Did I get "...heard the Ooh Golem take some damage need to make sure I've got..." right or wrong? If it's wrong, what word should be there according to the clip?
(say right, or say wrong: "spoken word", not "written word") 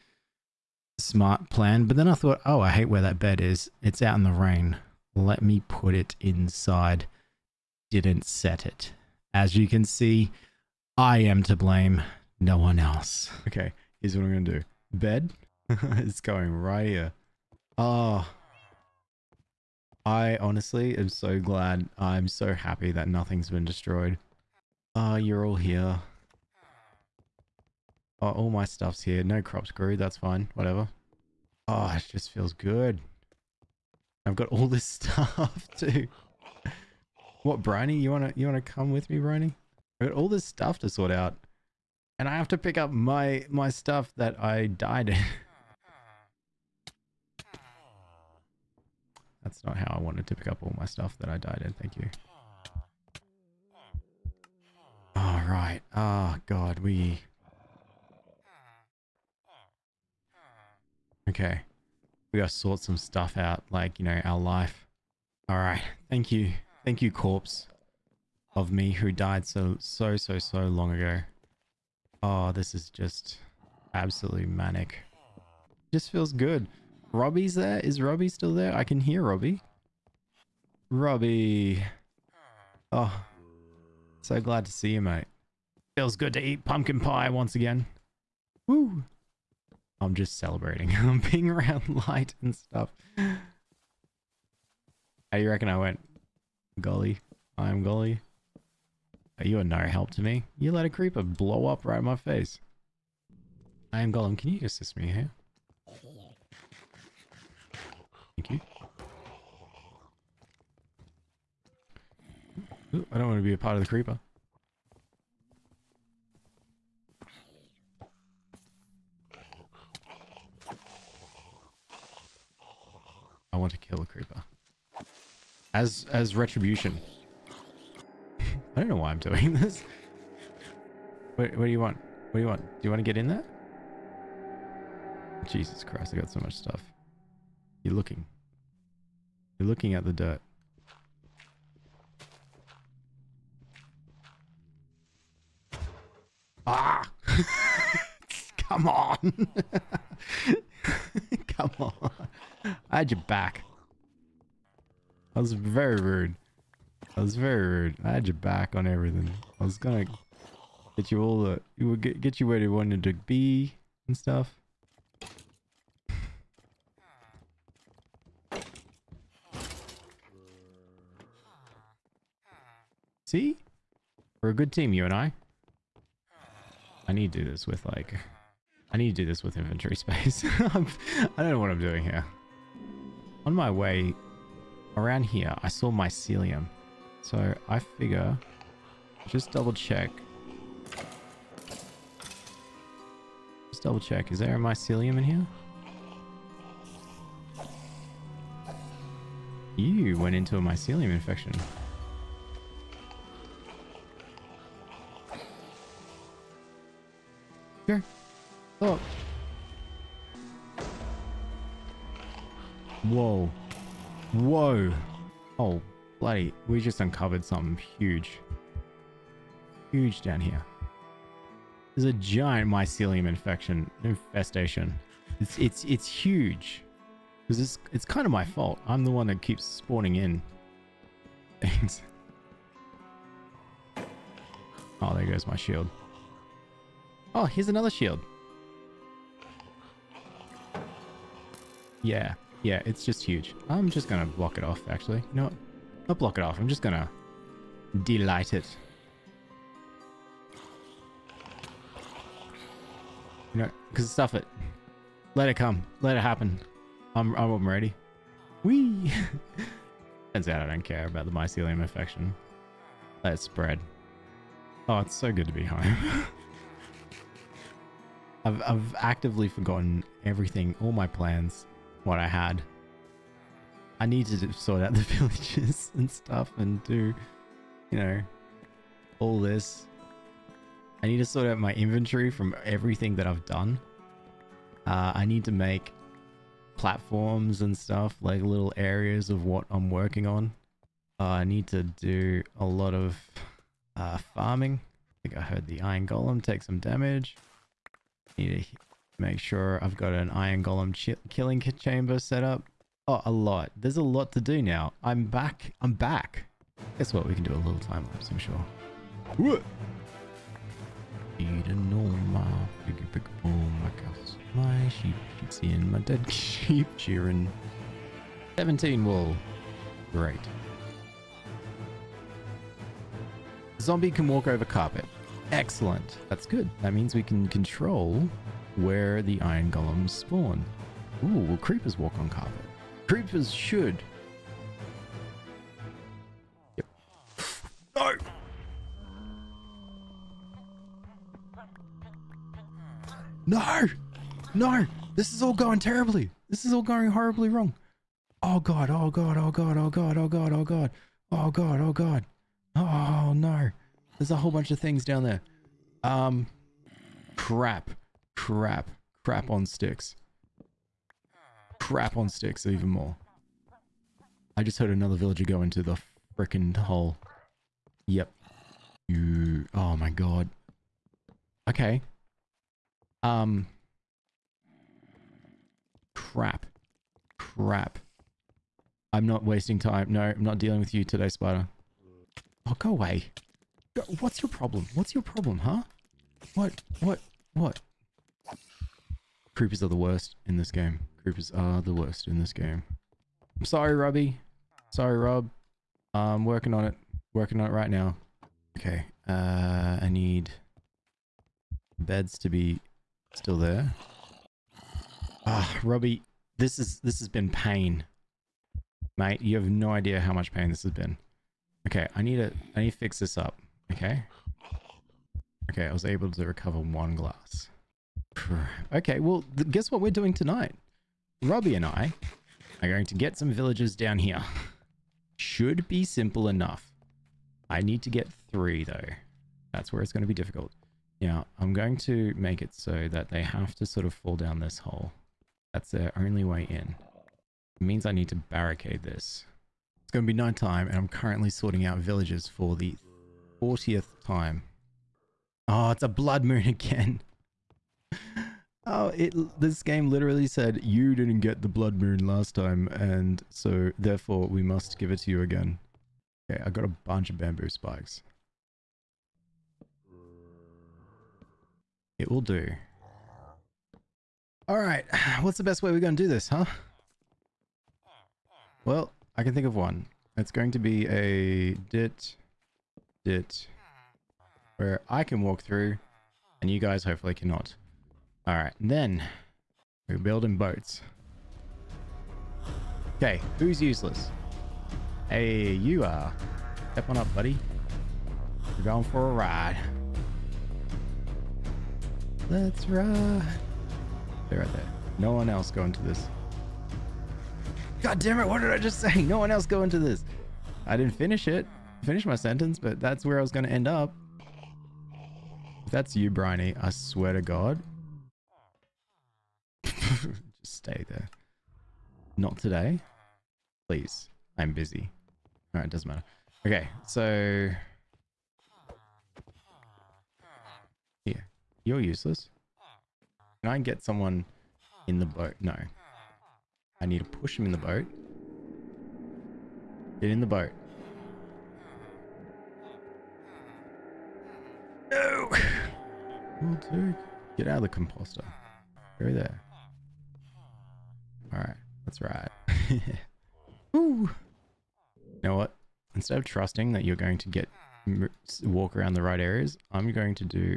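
wrong: "Iron", not "Ooh".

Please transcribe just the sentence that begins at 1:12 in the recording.
Oh, this is just absolutely manic.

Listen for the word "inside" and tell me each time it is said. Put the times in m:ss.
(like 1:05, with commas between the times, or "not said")
0:06.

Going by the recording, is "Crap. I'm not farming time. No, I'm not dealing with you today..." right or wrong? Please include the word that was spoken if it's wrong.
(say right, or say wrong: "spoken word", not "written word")
wrong: "wasting", not "farming".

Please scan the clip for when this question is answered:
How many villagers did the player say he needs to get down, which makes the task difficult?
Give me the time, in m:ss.
7:08.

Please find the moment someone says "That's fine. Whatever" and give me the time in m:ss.
0:29.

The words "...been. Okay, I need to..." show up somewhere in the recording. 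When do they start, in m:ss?
6:50.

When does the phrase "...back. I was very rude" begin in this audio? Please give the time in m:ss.
2:33.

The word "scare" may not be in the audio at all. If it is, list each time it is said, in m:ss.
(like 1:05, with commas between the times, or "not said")
not said.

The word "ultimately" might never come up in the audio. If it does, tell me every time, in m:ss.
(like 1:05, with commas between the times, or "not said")
not said.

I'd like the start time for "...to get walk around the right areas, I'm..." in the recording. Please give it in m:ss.
9:07.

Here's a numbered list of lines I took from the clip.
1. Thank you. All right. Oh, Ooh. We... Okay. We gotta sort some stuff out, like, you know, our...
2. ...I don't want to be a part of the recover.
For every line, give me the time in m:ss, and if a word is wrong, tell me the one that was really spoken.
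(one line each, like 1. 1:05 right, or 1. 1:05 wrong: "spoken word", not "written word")
1. 0:51 wrong: "God", not "Ooh"
2. 1:53 wrong: "creeper", not "recover".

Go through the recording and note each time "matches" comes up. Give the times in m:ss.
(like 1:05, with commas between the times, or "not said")
not said.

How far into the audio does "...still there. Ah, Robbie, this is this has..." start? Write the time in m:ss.
6:43.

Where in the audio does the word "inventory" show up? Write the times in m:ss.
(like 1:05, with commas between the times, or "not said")
2:59, 4:41.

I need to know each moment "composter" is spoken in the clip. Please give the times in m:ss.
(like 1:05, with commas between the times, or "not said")
8:57.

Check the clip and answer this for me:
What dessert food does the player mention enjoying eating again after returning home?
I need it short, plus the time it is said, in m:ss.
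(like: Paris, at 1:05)
Pumpkin pie, at 1:26.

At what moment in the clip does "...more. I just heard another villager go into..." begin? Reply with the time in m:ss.
6:02.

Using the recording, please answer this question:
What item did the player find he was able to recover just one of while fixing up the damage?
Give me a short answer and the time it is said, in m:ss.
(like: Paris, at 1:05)
Glass, at 6:56.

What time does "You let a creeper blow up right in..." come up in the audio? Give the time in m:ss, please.
1:40.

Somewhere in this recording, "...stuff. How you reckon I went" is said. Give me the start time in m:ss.
1:32.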